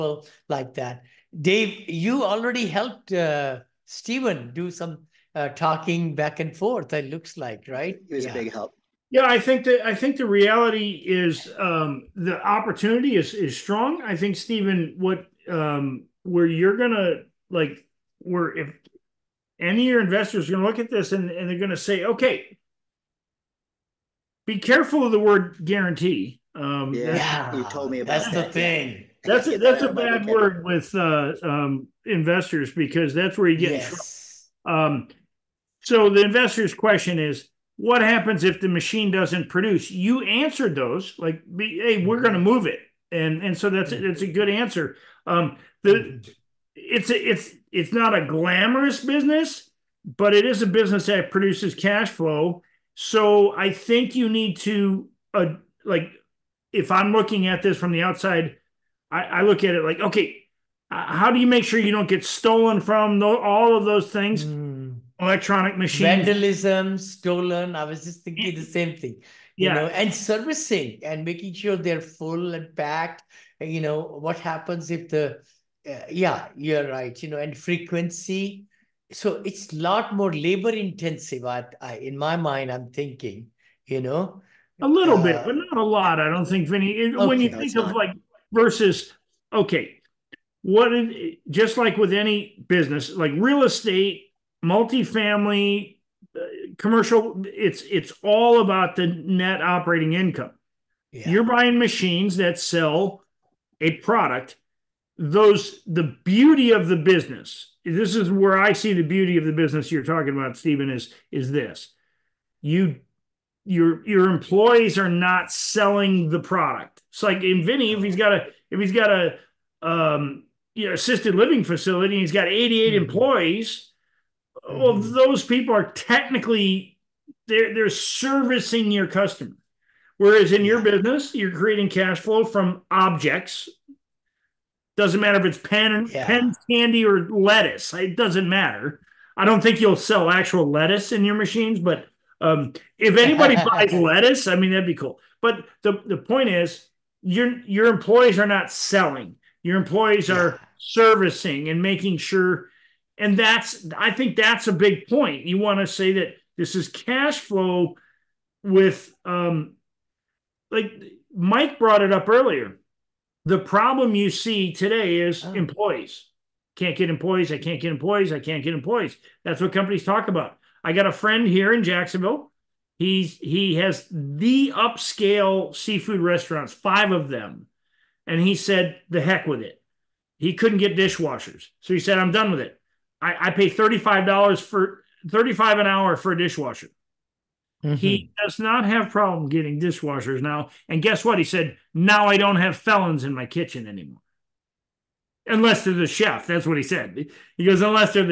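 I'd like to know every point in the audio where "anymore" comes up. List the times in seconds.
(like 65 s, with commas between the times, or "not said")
193 s.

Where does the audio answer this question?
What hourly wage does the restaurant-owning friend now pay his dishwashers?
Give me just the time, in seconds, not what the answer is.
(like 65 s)
185 s.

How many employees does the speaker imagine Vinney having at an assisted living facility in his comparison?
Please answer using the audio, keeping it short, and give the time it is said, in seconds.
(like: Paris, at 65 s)
88, at 122 s.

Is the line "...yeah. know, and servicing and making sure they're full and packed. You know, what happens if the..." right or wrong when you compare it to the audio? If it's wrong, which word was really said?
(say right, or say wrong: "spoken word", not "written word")
right.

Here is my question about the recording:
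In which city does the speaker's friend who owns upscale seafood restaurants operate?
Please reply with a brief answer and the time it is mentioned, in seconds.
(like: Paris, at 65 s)
Jacksonville, at 171 s.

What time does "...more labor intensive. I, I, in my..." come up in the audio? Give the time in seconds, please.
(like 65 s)
80 s.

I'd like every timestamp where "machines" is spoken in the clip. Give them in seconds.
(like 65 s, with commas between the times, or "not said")
38 s, 65 s, 101 s, 141 s.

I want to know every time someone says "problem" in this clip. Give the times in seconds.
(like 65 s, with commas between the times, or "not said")
163 s, 189 s.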